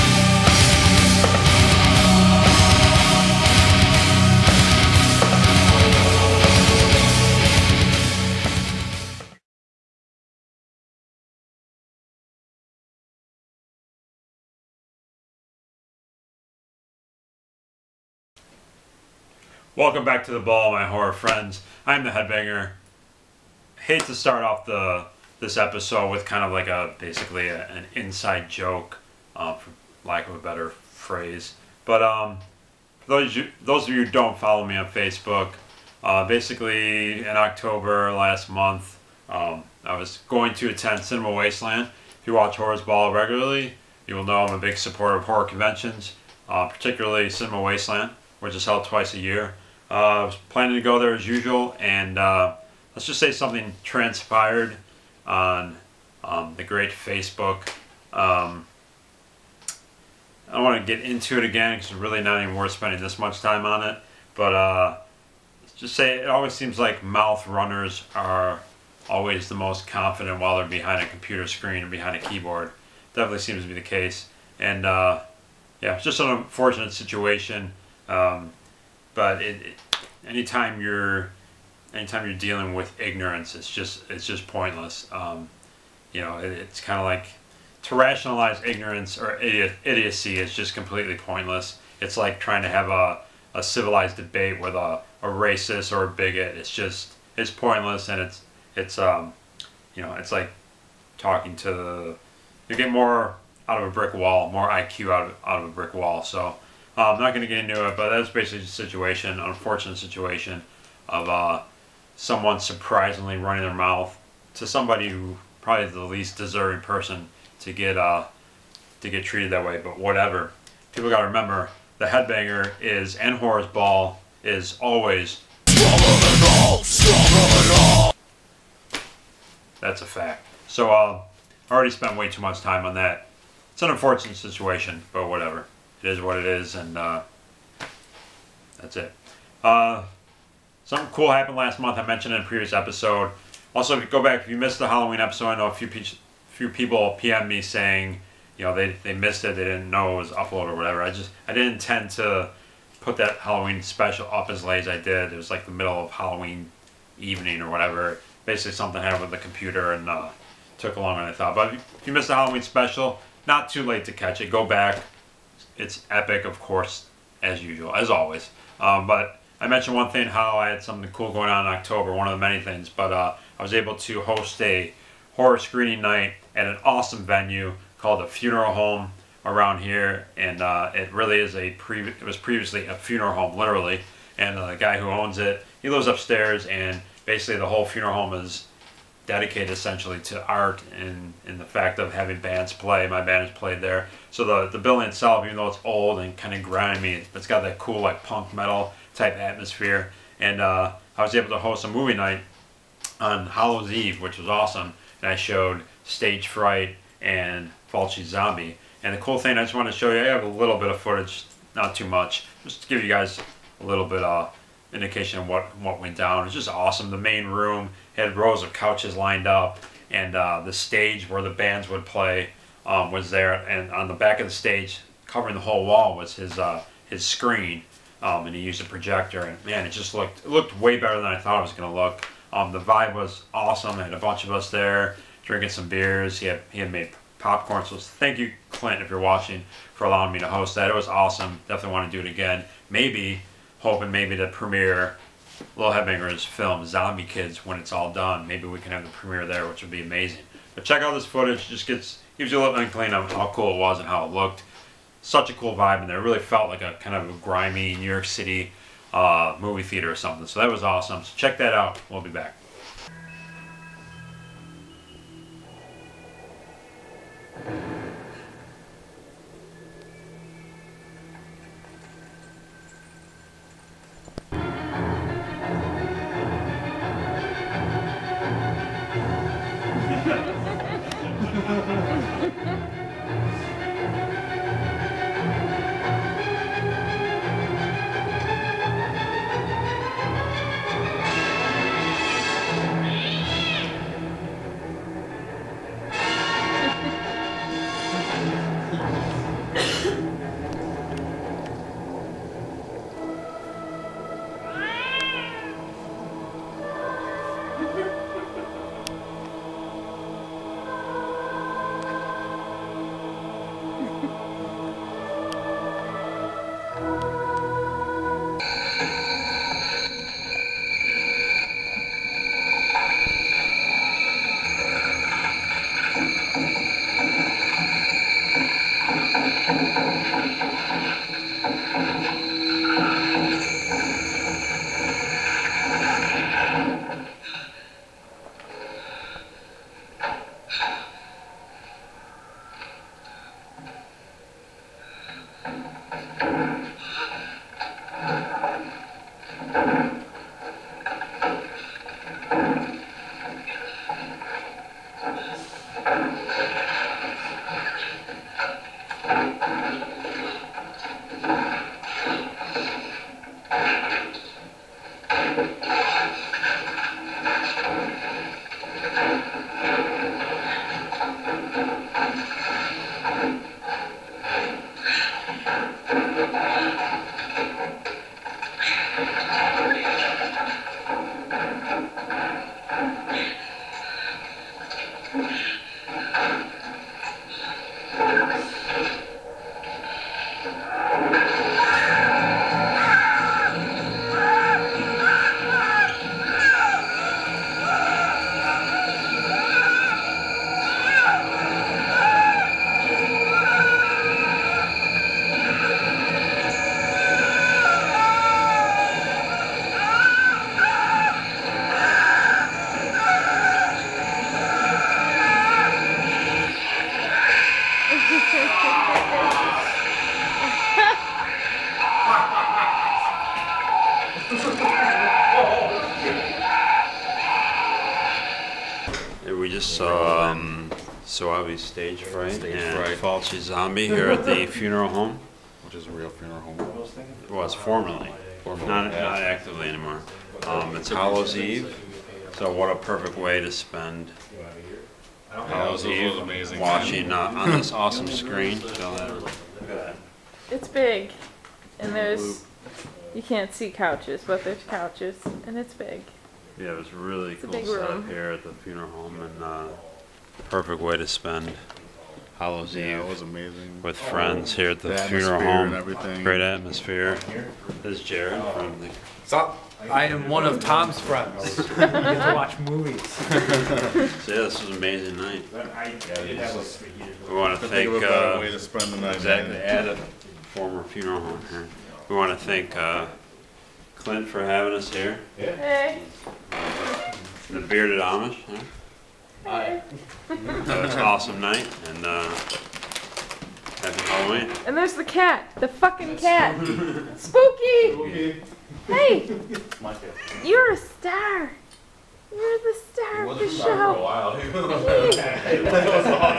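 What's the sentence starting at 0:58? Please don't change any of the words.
Um, I don't want to get into it again because it's really not even worth spending this much time on it.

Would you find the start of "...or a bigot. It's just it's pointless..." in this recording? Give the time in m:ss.
1:35.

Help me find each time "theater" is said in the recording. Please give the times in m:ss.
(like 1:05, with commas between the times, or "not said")
4:19.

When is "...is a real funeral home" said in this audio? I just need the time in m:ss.
7:15.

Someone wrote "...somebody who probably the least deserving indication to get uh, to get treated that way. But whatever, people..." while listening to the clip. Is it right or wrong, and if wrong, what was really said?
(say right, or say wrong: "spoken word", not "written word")
wrong: "person", not "indication".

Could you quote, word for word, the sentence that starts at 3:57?
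So thank you, Clint, if you're watching, for allowing me to host that.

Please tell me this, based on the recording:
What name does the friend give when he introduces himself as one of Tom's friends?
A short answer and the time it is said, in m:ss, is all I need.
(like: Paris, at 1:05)
Jared, at 7:48.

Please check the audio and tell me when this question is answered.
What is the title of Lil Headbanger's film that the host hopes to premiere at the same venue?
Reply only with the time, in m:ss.
4:06.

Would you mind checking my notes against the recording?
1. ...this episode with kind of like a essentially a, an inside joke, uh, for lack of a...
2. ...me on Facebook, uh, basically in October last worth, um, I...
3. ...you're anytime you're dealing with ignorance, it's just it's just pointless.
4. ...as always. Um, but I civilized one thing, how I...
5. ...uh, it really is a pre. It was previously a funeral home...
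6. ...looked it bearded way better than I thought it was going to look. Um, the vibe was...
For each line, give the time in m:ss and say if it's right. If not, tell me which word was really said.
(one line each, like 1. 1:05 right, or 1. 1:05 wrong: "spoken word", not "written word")
1. 0:25 wrong: "basically", not "essentially"
2. 0:34 wrong: "month", not "worth"
3. 1:20 right
4. 2:47 wrong: "mentioned", not "civilized"
5. 3:00 right
6. 3:50 wrong: "looked", not "bearded".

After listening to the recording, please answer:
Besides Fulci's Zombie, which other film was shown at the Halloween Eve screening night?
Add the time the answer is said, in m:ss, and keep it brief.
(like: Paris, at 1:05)
Stage Fright, at 3:26.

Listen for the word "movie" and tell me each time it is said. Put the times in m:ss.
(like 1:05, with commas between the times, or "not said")
3:21, 4:19, 7:52.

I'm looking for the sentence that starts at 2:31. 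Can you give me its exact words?
I just I didn't intend to put that Halloween special up as late as I did.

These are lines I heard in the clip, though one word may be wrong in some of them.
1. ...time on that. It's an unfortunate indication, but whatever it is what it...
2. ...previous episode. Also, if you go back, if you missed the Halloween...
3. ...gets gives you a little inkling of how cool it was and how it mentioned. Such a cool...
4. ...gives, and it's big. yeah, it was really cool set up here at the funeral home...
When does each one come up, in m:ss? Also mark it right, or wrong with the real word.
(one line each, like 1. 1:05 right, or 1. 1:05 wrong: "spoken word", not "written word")
1. 2:12 wrong: "situation", not "indication"
2. 2:22 right
3. 4:11 wrong: "looked", not "mentioned"
4. 7:34 wrong: "couches", not "gives".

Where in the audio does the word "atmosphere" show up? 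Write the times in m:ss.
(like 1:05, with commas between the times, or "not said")
3:19, 7:46.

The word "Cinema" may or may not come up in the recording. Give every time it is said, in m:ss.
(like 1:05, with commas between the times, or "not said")
0:41, 0:47.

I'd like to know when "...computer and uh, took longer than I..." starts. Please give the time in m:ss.
2:39.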